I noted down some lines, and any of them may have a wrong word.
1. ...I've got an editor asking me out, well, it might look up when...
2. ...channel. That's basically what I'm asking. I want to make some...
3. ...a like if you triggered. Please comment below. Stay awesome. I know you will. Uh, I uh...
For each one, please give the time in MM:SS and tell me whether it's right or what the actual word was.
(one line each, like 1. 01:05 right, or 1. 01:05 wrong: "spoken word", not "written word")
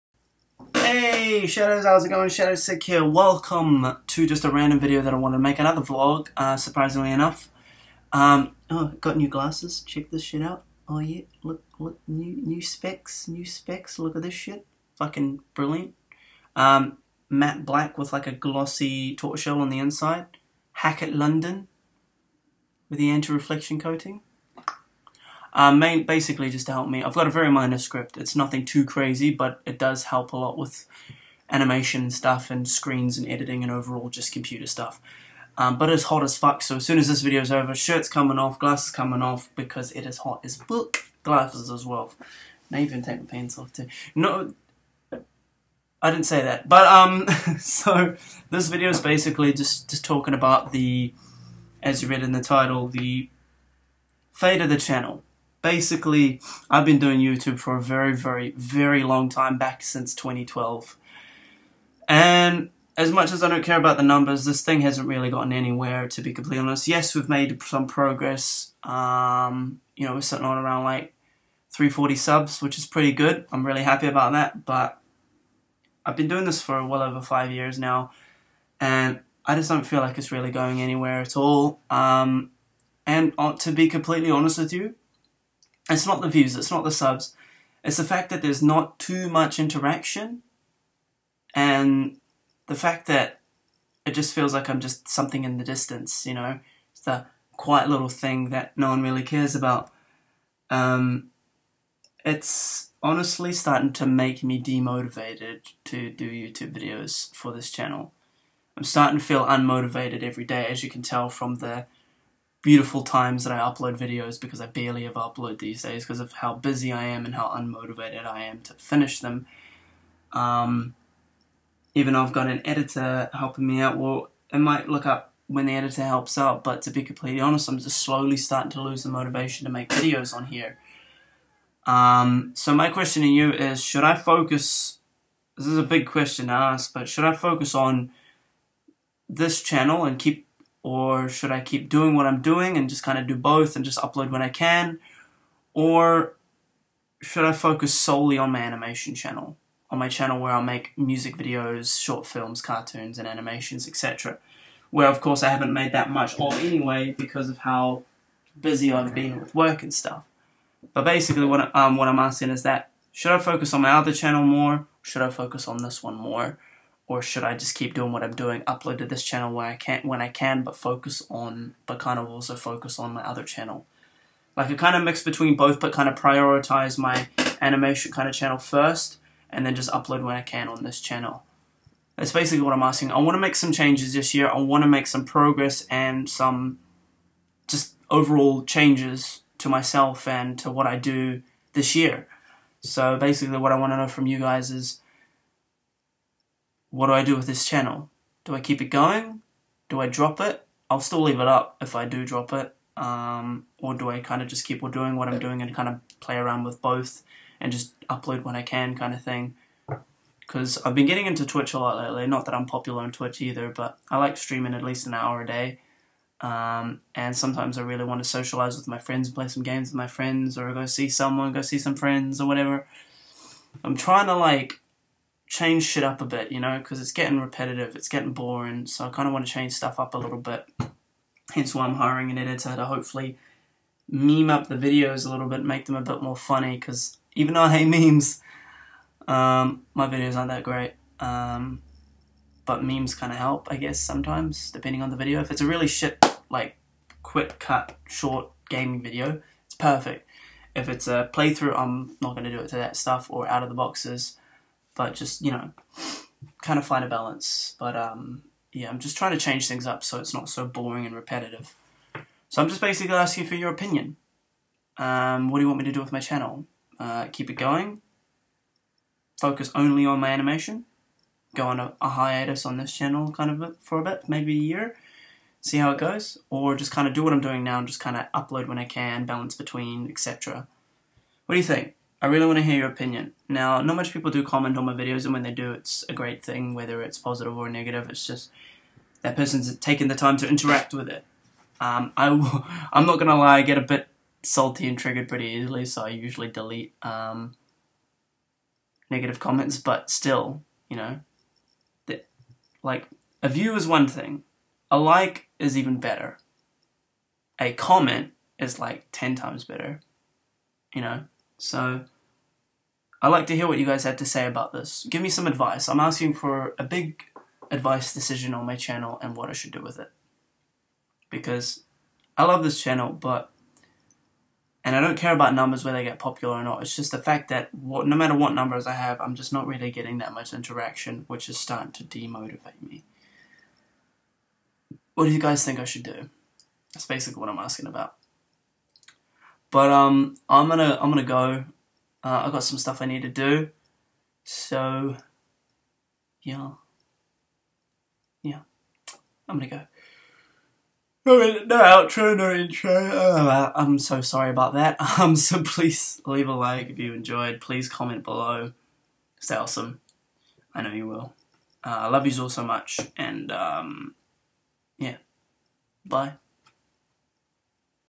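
1. 02:02 wrong: "helping", not "asking"
2. 03:01 right
3. 05:56 wrong: "enjoyed", not "triggered".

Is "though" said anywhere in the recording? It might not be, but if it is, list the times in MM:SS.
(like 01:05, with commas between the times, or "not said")
02:02, 03:57.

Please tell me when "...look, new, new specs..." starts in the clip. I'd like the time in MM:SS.
00:11.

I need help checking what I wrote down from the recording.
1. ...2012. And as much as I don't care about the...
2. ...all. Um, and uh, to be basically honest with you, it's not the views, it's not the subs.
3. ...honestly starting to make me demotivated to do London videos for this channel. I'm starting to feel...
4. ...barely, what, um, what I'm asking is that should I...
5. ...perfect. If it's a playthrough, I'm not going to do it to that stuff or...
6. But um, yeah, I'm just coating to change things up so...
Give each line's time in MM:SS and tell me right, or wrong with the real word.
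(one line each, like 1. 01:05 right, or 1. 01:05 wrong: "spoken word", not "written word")
1. 01:00 right
2. 01:21 wrong: "completely", not "basically"
3. 01:43 wrong: "YouTube", not "London"
4. 02:41 wrong: "basically", not "barely"
5. 04:09 right
6. 04:17 wrong: "trying", not "coating".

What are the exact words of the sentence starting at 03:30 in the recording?
Because I've been getting into Twitch a lot lately.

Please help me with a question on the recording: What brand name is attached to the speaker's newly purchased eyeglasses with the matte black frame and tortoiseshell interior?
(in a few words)
Hackett London.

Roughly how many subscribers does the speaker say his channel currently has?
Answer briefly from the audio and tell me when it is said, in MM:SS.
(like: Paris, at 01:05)
340, at 01:11.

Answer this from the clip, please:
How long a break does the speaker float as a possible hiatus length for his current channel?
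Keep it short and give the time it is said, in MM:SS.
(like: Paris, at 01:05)
a year, at 04:34.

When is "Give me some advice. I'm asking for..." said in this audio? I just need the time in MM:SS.
05:15.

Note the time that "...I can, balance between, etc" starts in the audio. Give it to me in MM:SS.
04:38.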